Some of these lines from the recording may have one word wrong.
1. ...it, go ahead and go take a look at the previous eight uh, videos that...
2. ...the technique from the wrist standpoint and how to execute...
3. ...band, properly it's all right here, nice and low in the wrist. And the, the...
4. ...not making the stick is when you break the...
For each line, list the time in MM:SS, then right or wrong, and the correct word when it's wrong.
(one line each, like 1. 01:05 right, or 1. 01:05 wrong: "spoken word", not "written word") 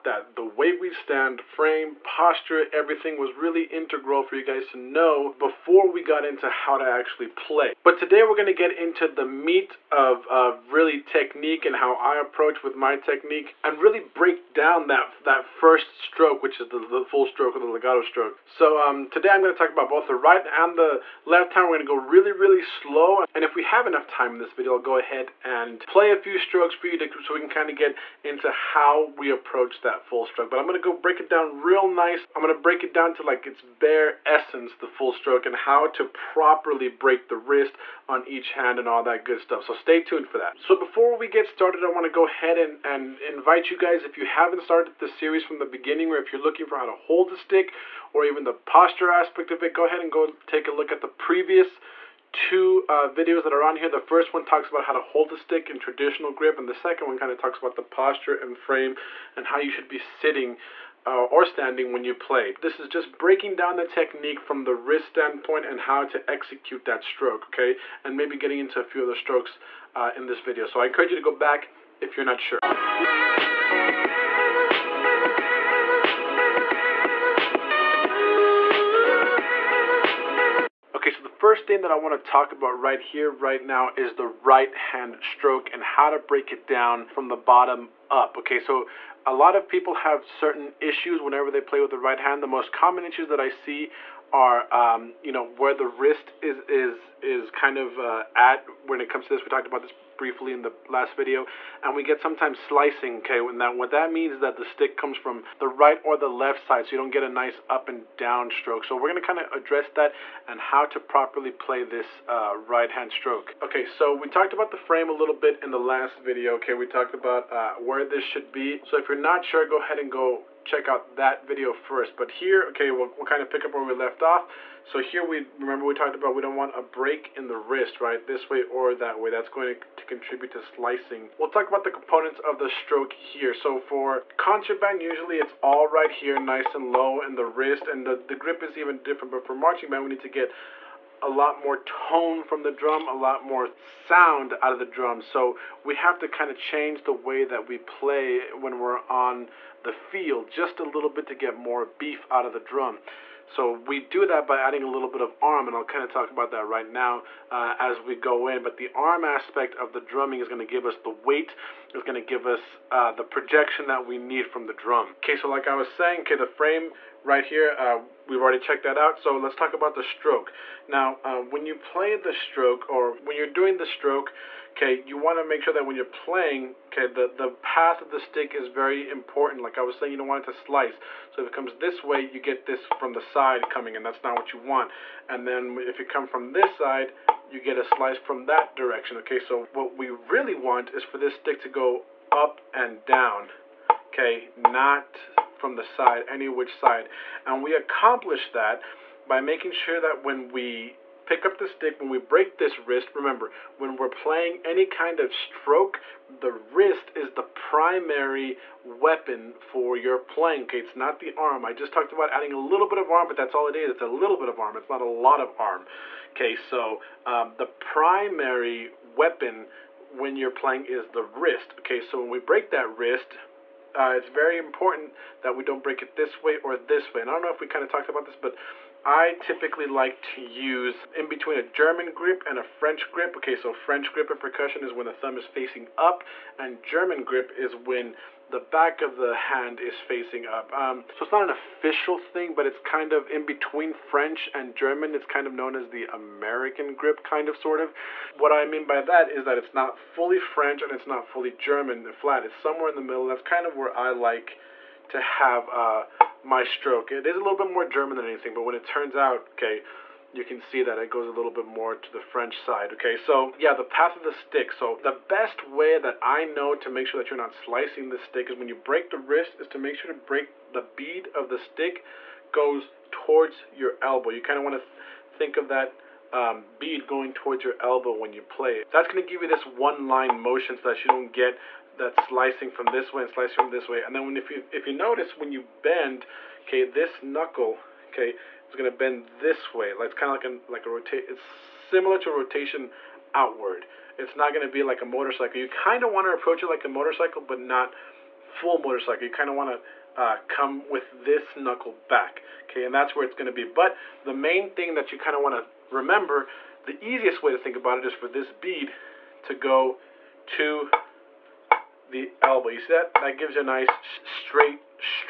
1. 00:49 wrong: "two", not "eight"
2. 01:03 right
3. 02:14 wrong: "usually", not "properly"
4. 04:27 wrong: "slicing", not "making".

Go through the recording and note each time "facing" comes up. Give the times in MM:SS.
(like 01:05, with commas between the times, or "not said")
03:55, 03:59.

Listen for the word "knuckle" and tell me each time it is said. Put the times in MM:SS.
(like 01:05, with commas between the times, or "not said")
04:47, 05:01.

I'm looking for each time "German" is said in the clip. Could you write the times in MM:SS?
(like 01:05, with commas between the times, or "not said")
03:51, 03:56, 04:04, 04:11, 04:17.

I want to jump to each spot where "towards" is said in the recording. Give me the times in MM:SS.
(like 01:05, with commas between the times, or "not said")
04:33, 04:37.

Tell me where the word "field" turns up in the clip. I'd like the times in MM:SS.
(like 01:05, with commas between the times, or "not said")
02:29.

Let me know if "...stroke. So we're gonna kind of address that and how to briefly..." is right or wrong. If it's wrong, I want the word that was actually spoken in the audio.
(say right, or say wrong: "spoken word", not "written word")
wrong: "properly", not "briefly".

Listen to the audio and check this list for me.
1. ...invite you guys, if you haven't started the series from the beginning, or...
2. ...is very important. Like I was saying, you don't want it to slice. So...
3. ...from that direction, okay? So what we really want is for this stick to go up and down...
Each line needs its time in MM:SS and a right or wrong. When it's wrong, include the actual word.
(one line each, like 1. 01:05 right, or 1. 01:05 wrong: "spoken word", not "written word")
1. 00:43 right
2. 02:58 right
3. 03:08 right.